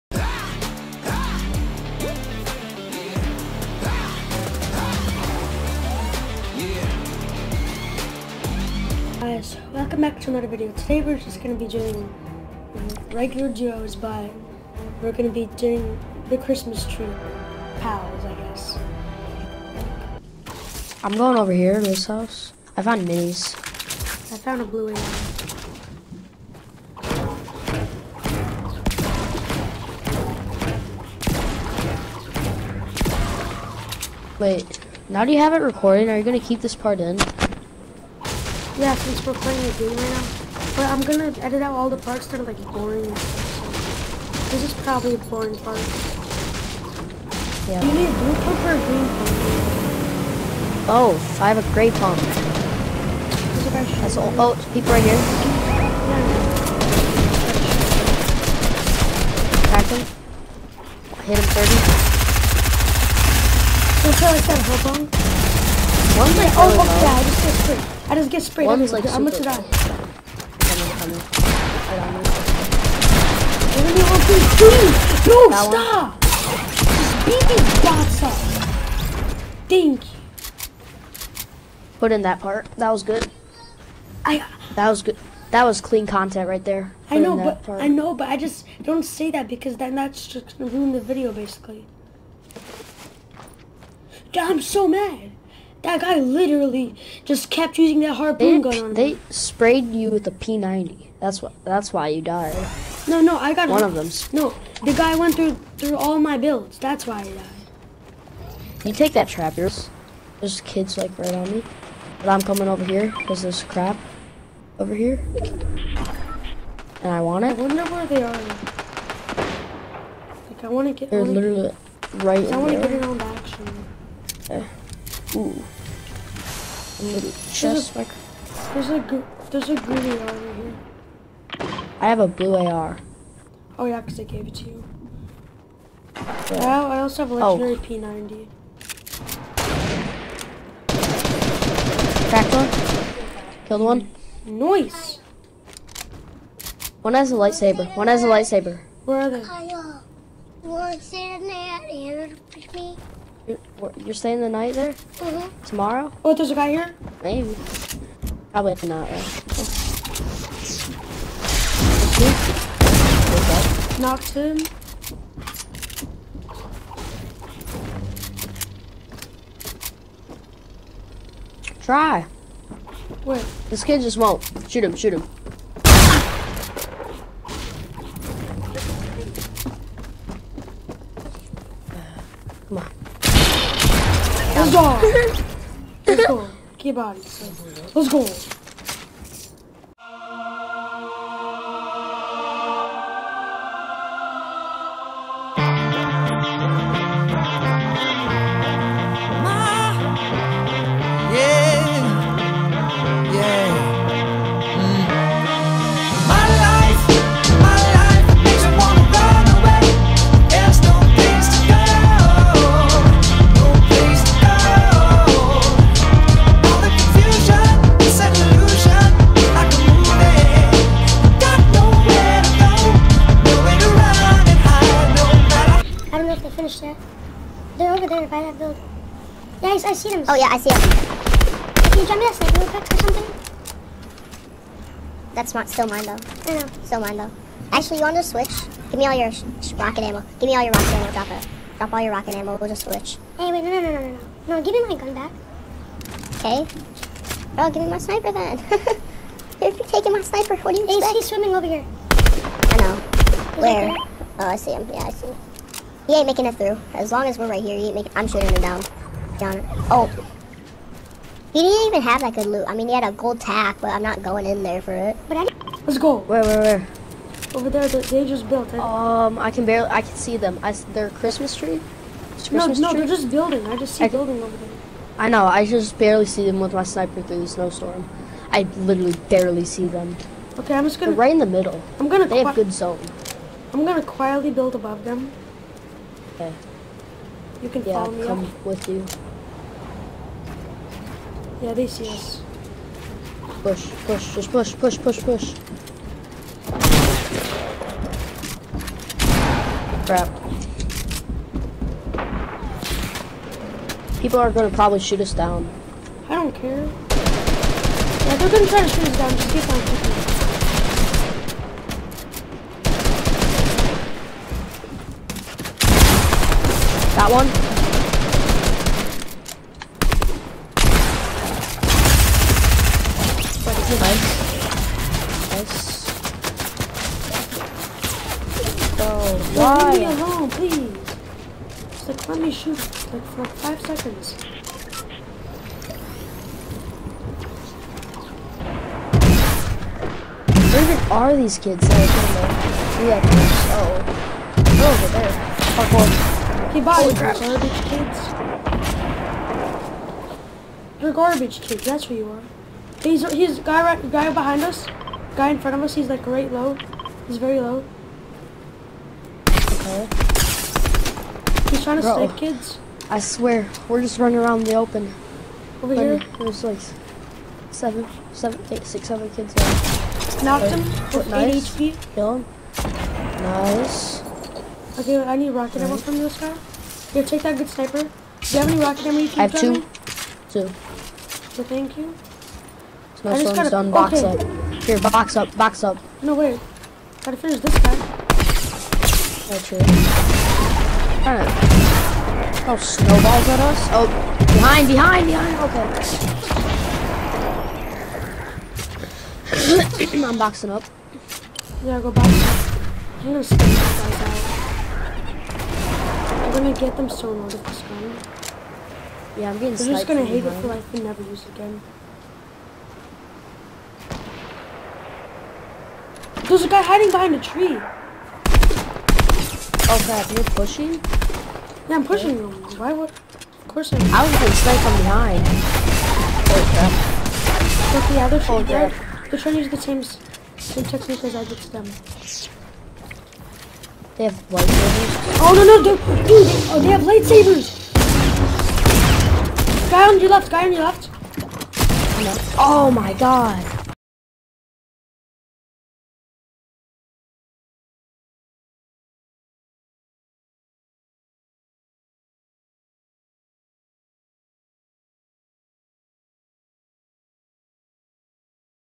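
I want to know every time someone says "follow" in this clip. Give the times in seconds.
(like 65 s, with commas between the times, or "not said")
287 s.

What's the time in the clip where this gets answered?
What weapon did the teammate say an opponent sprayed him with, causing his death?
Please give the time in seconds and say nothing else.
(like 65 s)
99 s.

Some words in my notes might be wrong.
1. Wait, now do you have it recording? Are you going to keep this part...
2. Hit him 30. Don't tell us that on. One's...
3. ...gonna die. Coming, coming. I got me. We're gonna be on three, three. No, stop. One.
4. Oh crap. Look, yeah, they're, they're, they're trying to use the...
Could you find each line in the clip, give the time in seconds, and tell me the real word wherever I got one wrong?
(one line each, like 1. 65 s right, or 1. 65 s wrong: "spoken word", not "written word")
1. 34 s right
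2. 61 s right
3. 69 s right
4. 426 s right.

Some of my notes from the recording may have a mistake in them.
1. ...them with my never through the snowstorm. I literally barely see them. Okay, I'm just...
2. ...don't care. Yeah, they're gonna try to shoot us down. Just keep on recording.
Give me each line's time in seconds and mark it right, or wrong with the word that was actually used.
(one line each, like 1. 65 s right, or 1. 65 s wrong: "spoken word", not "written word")
1. 276 s wrong: "sniper", not "never"
2. 306 s wrong: "shooting", not "recording".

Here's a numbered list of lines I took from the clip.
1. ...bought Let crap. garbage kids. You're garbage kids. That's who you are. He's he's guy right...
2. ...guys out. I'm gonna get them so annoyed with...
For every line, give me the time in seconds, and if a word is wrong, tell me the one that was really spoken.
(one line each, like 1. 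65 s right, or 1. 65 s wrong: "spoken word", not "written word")
1. 346 s wrong: "Holy", not "Let"
2. 403 s right.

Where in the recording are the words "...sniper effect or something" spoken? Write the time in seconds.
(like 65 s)
232 s.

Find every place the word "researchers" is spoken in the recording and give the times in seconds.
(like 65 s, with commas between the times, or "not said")
not said.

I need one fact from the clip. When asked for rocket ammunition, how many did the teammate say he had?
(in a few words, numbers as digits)
2.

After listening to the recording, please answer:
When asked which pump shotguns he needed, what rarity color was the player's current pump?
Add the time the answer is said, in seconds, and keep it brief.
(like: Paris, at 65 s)
Gray, at 51 s.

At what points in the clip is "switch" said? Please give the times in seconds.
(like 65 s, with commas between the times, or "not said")
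238 s, 242 s.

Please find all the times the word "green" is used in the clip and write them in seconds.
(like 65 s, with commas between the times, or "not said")
48 s, 129 s.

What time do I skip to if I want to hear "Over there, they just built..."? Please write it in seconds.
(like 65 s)
267 s.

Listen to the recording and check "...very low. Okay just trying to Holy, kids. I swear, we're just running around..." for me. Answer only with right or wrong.
wrong.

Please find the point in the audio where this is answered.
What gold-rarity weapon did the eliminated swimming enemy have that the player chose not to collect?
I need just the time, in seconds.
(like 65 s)
263 s.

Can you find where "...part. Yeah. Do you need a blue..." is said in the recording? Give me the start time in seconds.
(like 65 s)
45 s.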